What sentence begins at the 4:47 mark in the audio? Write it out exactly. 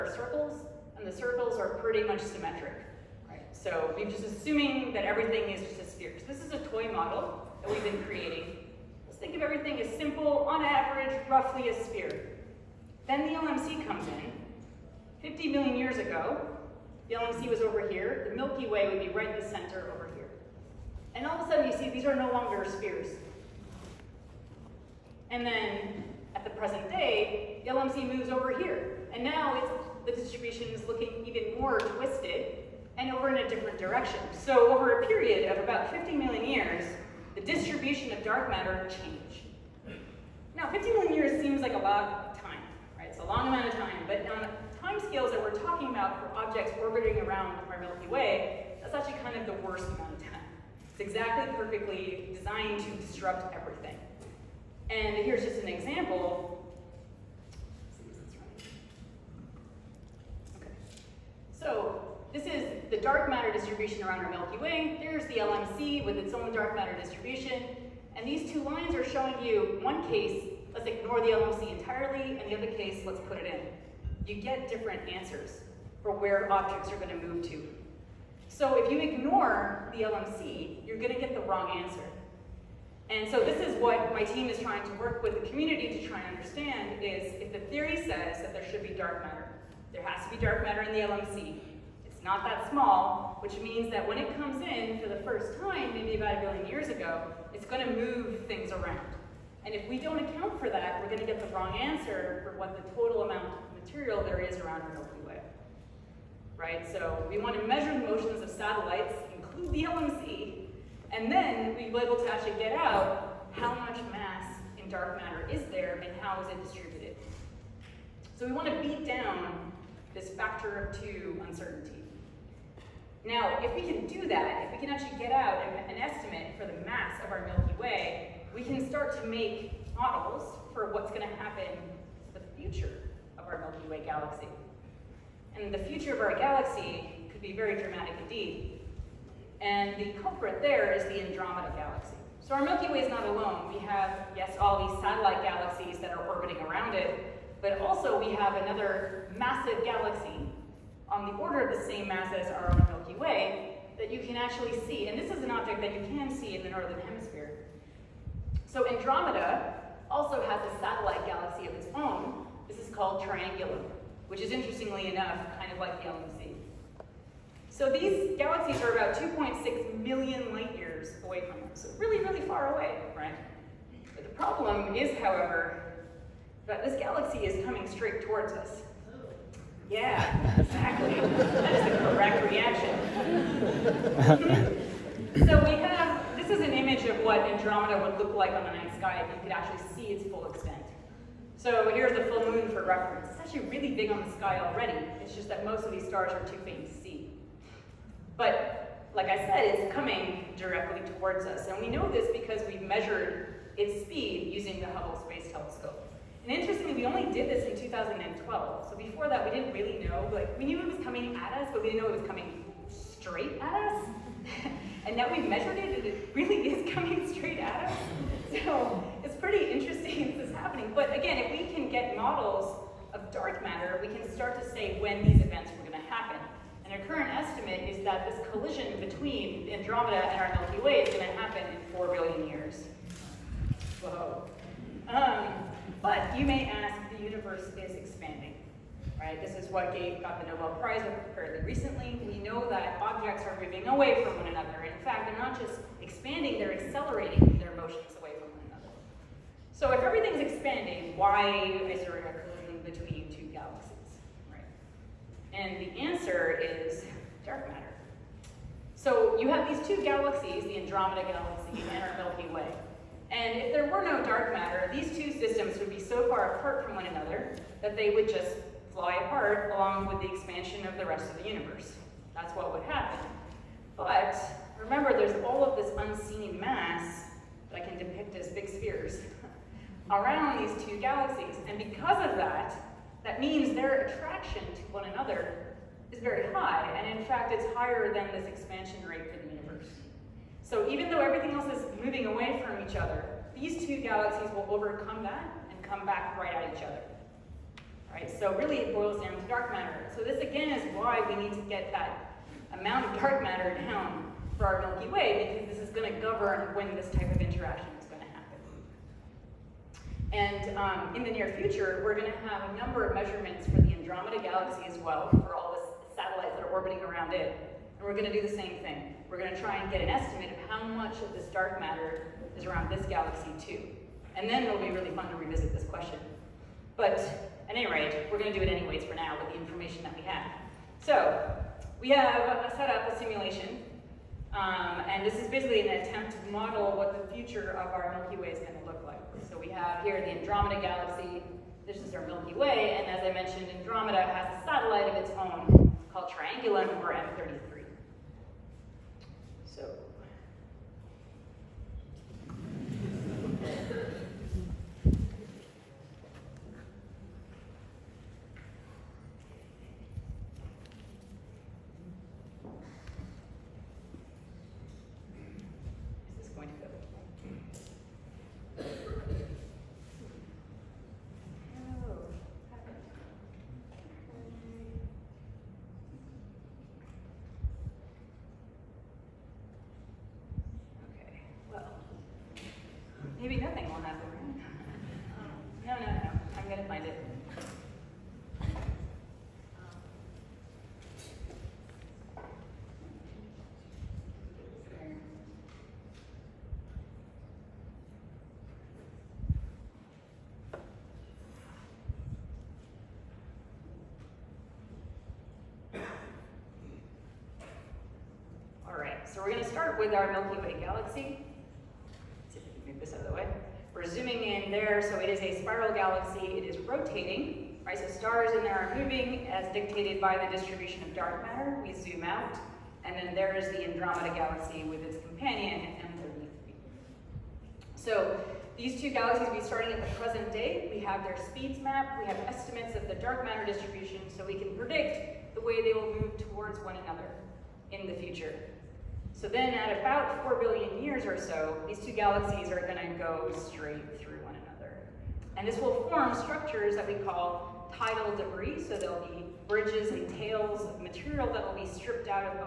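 And in fact, it's higher than this expansion rate for the universe.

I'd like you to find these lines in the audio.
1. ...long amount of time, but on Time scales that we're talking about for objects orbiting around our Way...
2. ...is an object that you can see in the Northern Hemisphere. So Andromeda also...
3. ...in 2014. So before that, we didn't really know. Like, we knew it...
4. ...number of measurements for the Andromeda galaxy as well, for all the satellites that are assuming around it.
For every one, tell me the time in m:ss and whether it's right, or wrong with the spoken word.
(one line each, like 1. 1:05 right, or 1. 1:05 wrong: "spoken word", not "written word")
1. 0:43 wrong: "Milky", not "Way"
2. 2:35 right
3. 3:27 wrong: "2012", not "2014"
4. 5:12 wrong: "orbiting", not "assuming".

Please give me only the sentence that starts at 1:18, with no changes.
So if you ignore the LMC, you're going to get the wrong answer.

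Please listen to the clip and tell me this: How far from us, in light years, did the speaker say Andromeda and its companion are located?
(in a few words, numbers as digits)
2.6 million light years.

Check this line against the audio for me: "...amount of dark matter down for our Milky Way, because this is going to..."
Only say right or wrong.
right.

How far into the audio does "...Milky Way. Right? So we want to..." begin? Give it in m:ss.
1:44.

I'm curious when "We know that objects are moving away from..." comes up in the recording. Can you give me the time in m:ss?
4:02.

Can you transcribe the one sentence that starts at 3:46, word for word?
And our current estimate is that this collision between Andromeda and our Milky Way is going to happen in 4 billion years.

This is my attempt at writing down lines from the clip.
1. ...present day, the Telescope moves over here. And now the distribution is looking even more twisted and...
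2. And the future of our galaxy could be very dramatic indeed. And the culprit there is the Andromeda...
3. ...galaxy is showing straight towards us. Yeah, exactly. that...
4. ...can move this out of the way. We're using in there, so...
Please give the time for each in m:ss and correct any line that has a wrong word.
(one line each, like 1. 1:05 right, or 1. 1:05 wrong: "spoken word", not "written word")
1. 0:26 wrong: "LMC", not "Telescope"
2. 2:15 right
3. 2:56 wrong: "coming", not "showing"
4. 6:52 wrong: "zooming", not "using".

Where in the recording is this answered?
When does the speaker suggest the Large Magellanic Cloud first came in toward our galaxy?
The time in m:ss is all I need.
1:36.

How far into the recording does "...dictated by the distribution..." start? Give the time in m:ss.
6:59.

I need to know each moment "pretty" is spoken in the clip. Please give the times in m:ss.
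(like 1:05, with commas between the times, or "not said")
0:01, 3:39.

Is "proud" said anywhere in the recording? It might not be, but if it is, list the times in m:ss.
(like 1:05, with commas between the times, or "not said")
not said.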